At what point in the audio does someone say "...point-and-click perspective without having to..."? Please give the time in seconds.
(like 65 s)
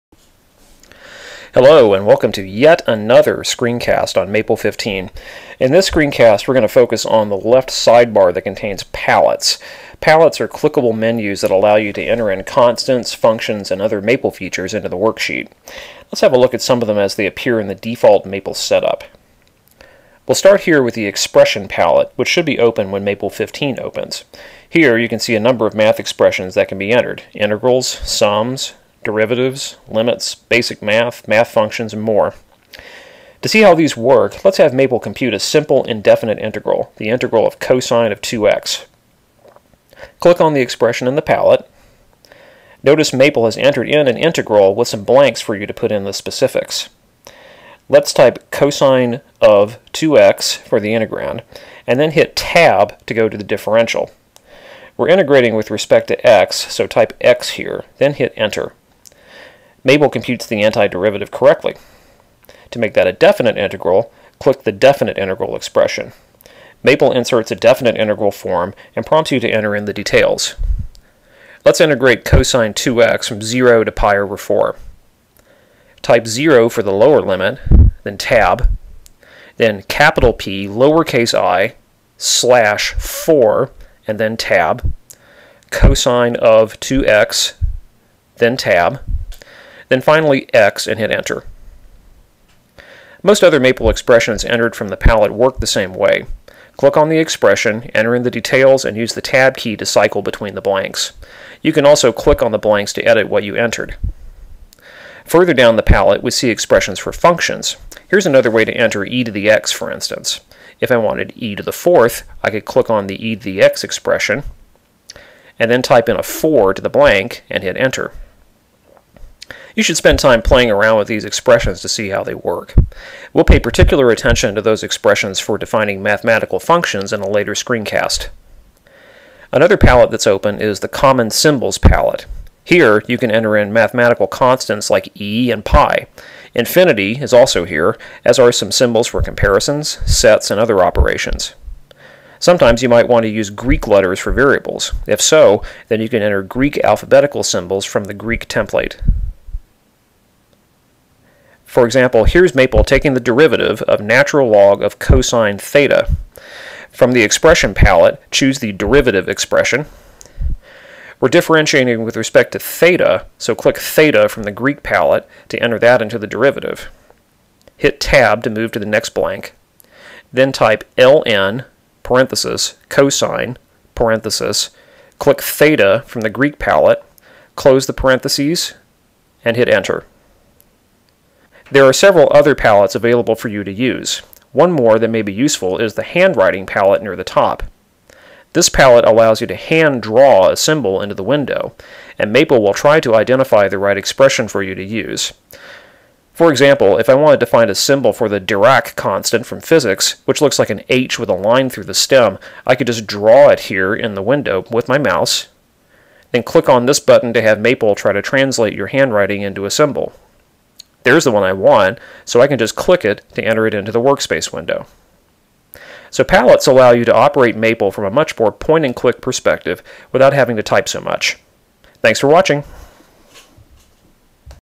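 218 s.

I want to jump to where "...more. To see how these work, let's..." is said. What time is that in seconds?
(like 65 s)
32 s.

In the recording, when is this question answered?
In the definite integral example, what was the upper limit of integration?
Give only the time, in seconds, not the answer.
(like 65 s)
73 s.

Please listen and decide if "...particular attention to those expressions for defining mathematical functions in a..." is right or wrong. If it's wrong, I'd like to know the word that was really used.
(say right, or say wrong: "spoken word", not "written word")
right.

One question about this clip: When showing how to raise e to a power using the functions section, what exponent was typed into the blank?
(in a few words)
4.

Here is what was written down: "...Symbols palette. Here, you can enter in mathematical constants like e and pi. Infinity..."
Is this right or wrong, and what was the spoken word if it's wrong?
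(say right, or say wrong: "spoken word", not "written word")
right.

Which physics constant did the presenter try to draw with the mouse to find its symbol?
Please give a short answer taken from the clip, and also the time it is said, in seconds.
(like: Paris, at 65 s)
Dirac constant, at 198 s.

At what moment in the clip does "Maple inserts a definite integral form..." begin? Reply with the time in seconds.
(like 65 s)
66 s.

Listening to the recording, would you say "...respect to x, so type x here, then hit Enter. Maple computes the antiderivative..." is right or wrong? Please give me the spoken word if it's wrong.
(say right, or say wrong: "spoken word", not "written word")
right.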